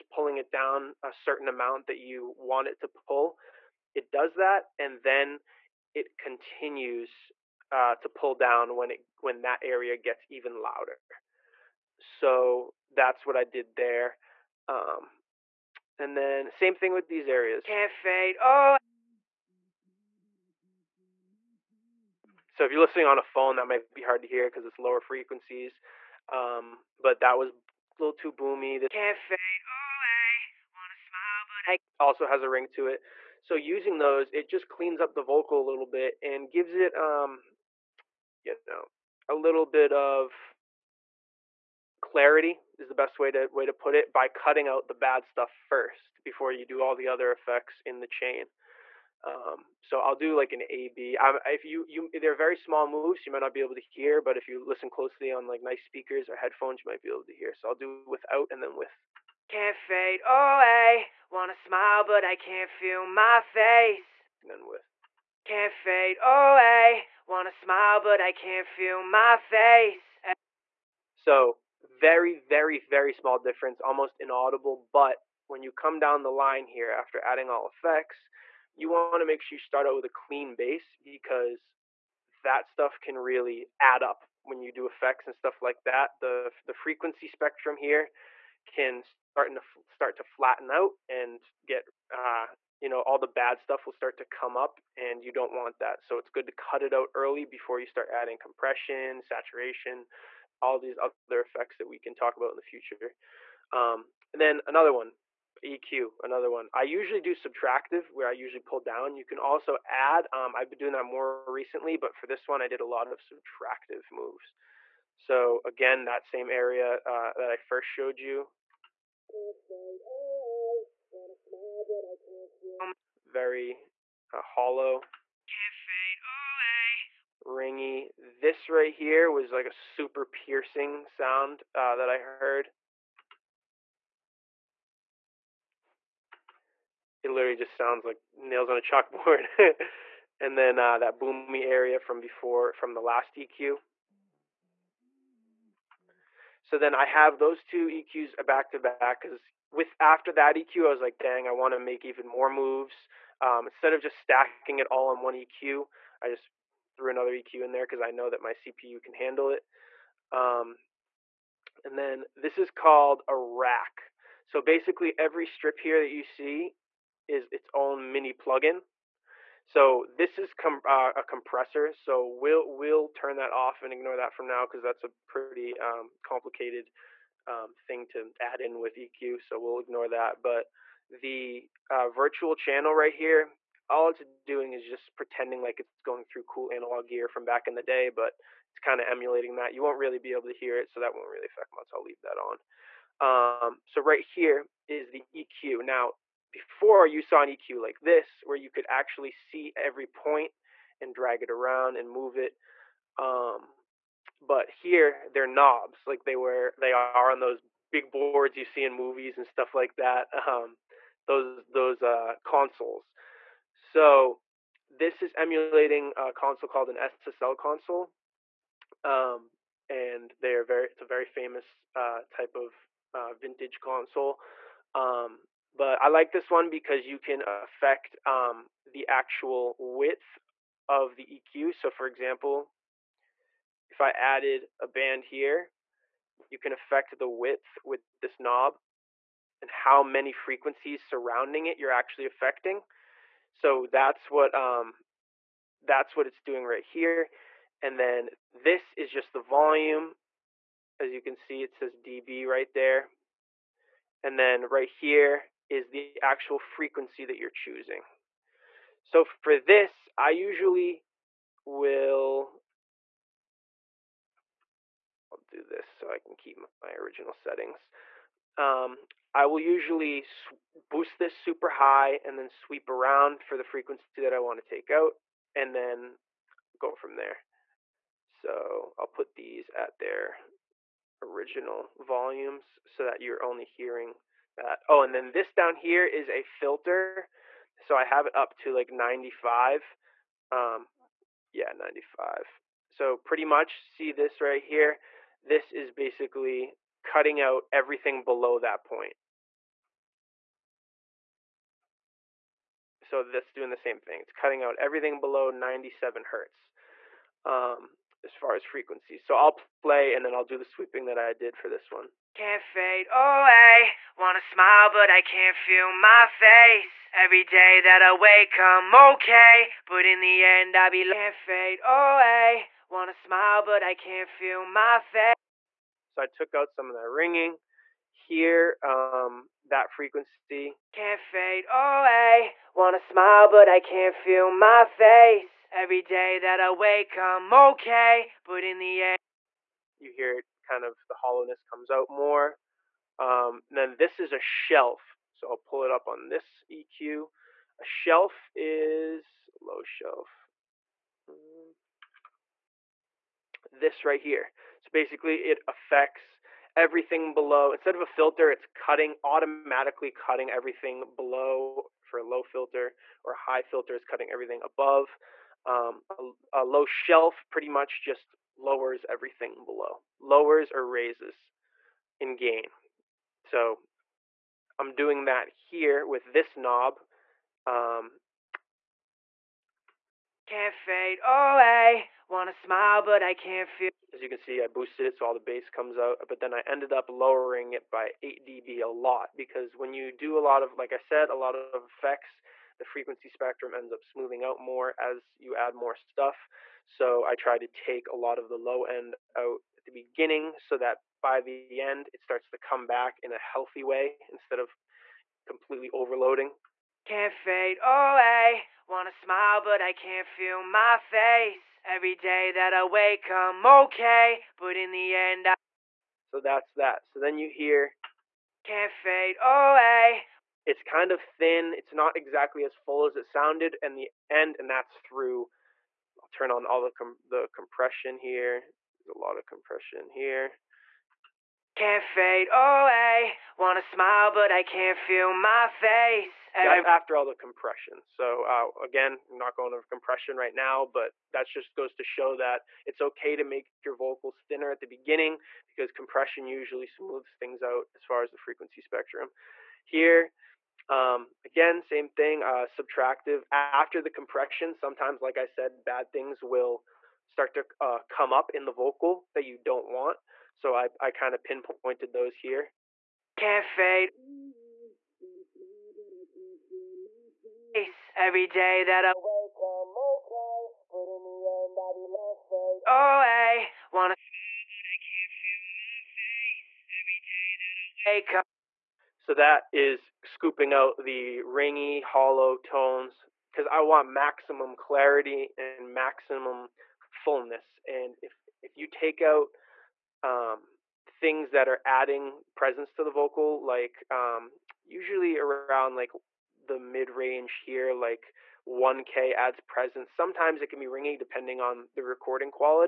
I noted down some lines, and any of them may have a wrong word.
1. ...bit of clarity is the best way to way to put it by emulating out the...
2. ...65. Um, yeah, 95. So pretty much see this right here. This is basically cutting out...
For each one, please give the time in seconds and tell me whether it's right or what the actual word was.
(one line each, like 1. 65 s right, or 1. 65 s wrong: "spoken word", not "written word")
1. 39 s wrong: "cutting", not "emulating"
2. 288 s wrong: "95", not "65".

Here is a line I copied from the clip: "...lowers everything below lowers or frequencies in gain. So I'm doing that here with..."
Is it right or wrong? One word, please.
wrong.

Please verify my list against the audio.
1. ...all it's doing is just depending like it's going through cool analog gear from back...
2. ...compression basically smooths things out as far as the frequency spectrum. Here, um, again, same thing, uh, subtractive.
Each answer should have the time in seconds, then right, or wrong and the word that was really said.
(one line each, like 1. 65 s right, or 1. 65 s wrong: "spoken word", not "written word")
1. 183 s wrong: "pretending", not "depending"
2. 445 s wrong: "usually", not "basically".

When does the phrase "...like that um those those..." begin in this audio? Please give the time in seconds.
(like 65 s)
209 s.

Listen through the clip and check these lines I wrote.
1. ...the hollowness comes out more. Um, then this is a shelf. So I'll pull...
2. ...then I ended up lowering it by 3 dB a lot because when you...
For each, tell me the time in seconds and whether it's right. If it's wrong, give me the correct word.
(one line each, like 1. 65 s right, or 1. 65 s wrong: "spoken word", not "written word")
1. 341 s right
2. 386 s wrong: "8", not "3".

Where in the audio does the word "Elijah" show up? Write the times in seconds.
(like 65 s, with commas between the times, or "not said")
not said.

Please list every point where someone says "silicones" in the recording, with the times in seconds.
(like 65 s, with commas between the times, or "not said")
not said.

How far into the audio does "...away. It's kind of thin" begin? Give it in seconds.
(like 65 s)
419 s.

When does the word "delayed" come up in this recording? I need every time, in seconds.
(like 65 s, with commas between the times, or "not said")
not said.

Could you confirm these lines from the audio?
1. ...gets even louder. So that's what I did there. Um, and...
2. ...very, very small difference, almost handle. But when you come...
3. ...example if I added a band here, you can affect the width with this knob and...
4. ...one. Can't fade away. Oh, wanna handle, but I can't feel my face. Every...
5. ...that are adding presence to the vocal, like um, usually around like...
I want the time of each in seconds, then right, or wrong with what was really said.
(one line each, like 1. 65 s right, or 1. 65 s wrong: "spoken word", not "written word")
1. 9 s right
2. 72 s wrong: "inaudible", not "handle"
3. 232 s right
4. 311 s wrong: "smile", not "handle"
5. 491 s right.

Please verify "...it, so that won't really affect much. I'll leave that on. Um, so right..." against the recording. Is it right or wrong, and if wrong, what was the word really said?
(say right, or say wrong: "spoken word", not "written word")
right.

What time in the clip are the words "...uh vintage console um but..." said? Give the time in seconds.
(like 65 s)
223 s.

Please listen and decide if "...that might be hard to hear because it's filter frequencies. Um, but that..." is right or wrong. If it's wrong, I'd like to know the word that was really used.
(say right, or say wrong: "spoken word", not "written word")
wrong: "lower", not "filter".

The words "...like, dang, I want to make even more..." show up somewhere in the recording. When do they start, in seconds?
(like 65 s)
151 s.